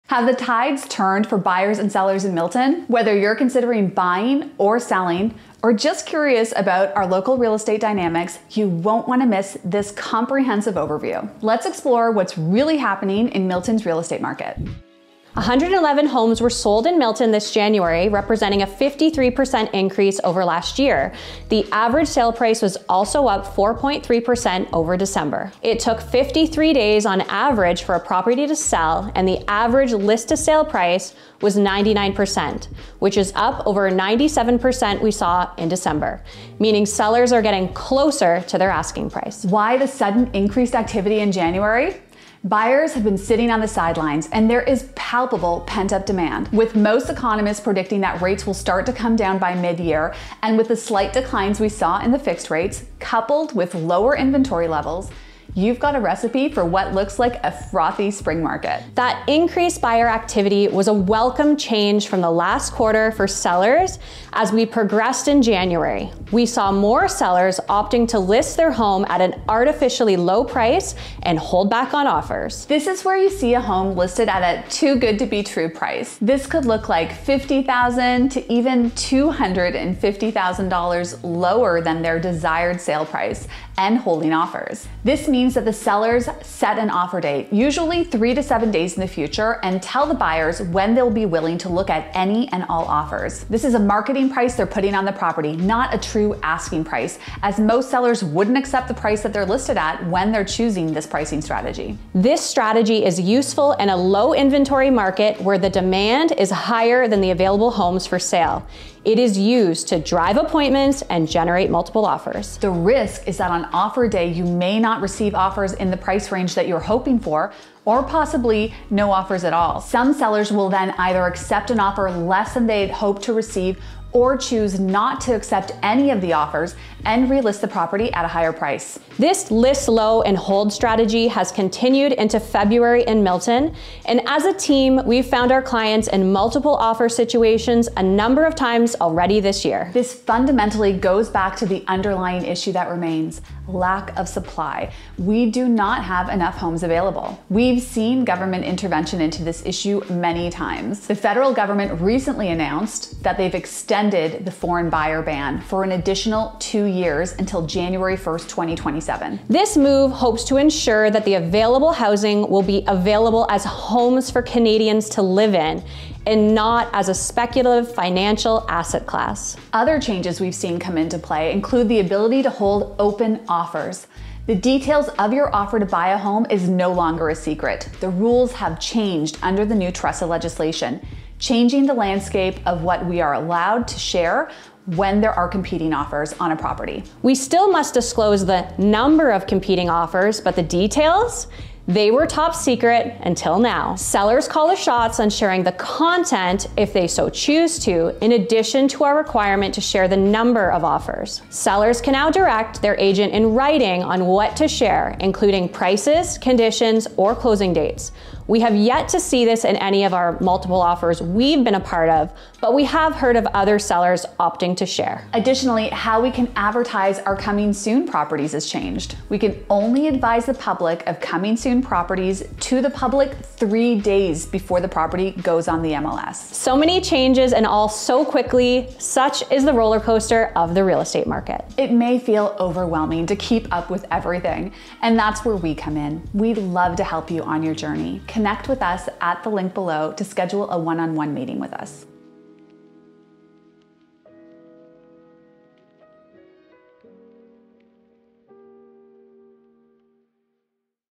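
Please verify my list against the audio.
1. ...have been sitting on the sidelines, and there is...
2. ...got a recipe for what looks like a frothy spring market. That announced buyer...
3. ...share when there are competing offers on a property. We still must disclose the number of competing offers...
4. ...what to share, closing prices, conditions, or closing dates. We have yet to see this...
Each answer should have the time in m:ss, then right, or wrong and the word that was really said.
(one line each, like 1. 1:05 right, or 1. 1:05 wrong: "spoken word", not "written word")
1. 0:42 right
2. 0:55 wrong: "increased", not "announced"
3. 3:03 right
4. 3:24 wrong: "including", not "closing".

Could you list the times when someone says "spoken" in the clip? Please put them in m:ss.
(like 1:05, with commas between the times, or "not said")
not said.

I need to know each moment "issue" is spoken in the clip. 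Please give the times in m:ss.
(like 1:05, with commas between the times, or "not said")
2:22, 2:29.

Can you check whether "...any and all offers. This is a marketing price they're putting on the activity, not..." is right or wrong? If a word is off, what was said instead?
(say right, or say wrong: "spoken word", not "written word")
wrong: "property", not "activity".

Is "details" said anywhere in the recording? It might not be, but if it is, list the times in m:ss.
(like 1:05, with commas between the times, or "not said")
2:54, 3:10.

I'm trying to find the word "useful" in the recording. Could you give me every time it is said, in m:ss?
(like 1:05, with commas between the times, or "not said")
1:43.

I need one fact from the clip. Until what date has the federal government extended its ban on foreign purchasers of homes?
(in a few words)
January 1st, 2027.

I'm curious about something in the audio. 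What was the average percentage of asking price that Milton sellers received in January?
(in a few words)
99%.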